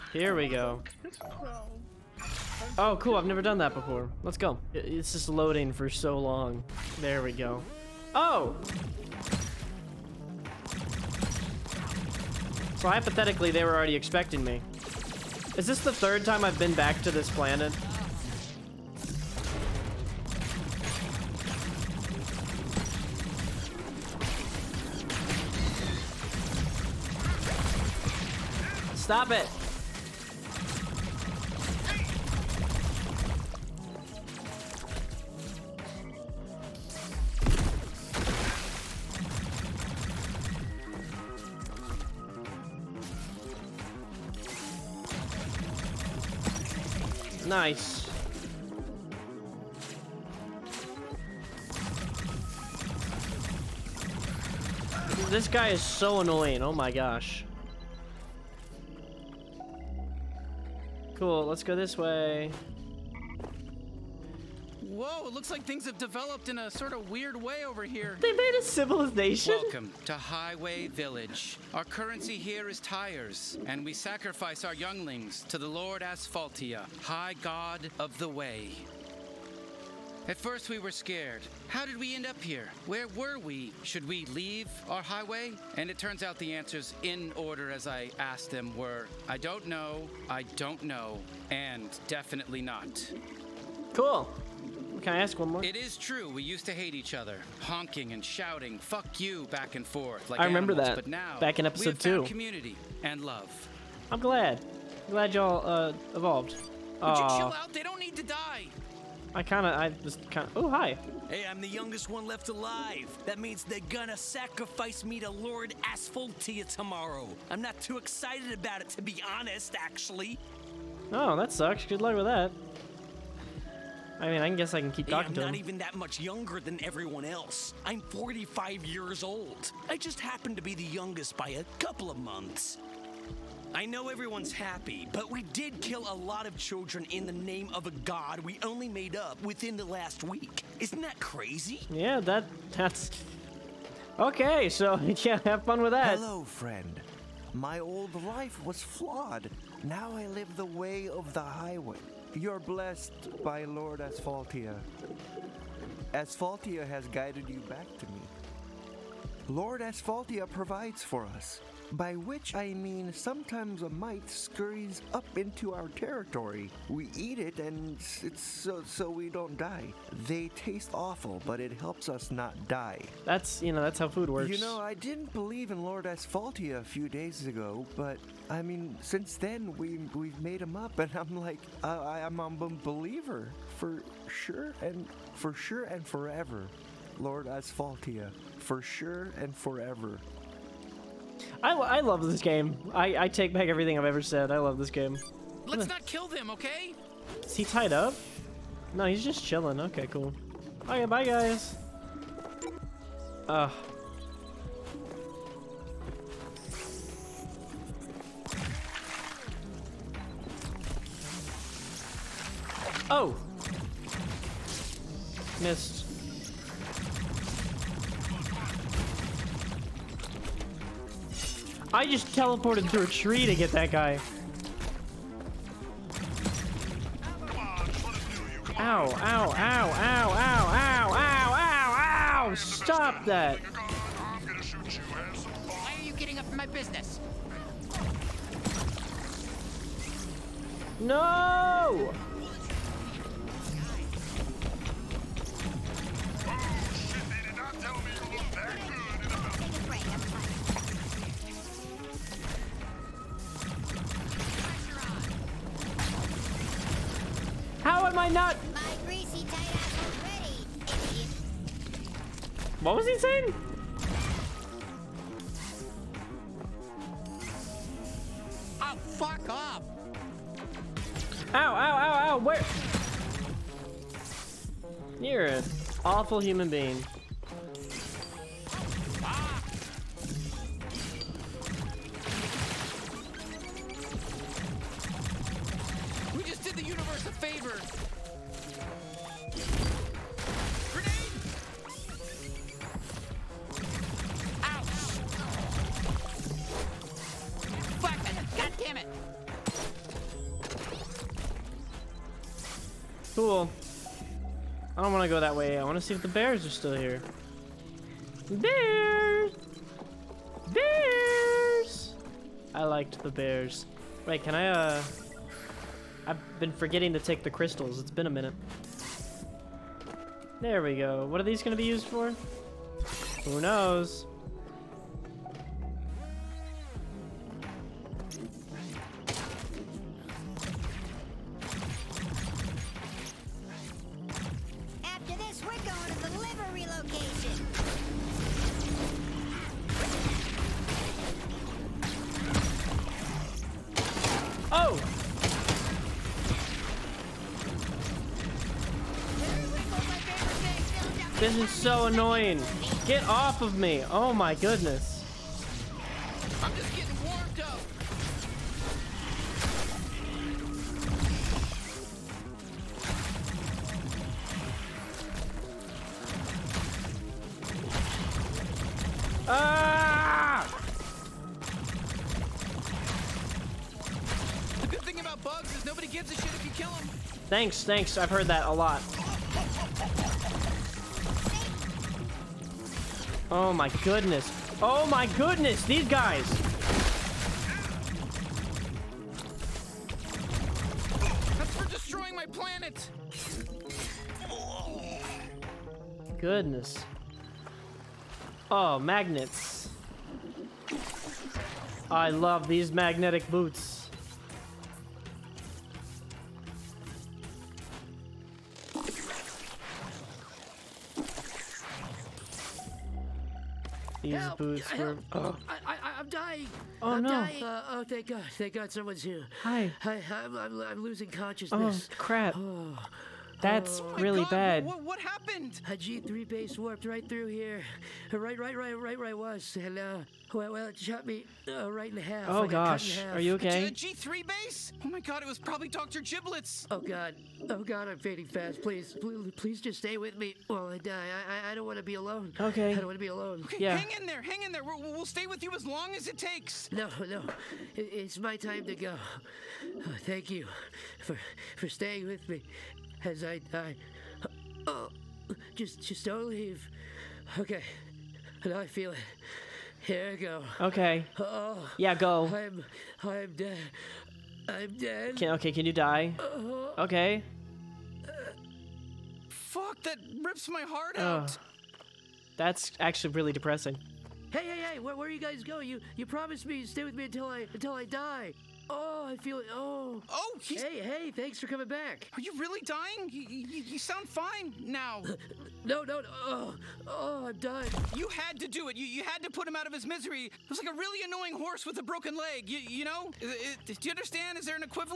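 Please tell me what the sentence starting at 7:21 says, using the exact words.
I, I, don't want to be alone.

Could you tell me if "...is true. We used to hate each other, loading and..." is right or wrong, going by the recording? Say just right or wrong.
wrong.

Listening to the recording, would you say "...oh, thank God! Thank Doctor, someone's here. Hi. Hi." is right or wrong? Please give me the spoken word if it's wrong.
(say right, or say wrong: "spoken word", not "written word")
wrong: "God", not "Doctor".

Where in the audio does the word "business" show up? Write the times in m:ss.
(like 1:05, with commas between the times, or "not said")
3:56.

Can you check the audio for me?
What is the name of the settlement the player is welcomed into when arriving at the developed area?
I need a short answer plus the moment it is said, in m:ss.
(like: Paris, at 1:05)
Highway Village, at 1:10.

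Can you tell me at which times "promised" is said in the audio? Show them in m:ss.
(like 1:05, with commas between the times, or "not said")
7:56.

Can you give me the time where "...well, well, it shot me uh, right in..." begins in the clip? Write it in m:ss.
7:10.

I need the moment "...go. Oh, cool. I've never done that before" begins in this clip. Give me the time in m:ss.
0:00.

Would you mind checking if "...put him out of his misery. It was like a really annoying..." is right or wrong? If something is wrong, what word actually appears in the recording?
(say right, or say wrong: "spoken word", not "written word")
right.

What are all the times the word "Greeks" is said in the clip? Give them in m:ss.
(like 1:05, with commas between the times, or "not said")
not said.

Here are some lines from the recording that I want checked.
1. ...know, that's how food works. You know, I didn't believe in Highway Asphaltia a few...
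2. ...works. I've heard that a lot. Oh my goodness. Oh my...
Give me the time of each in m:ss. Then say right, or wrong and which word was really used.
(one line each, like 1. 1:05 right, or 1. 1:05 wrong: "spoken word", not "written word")
1. 2:53 wrong: "Lord", not "Highway"
2. 6:17 wrong: "thanks", not "works".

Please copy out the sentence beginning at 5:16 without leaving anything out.
I've been forgetting to take the crystals.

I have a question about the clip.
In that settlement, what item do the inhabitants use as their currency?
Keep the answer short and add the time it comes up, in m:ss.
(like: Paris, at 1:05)
Tires, at 1:12.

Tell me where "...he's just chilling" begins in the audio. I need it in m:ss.
3:19.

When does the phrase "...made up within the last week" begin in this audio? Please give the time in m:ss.
2:18.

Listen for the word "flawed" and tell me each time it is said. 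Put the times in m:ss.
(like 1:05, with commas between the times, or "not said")
2:28.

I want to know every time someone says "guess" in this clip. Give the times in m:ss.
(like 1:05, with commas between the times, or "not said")
2:04.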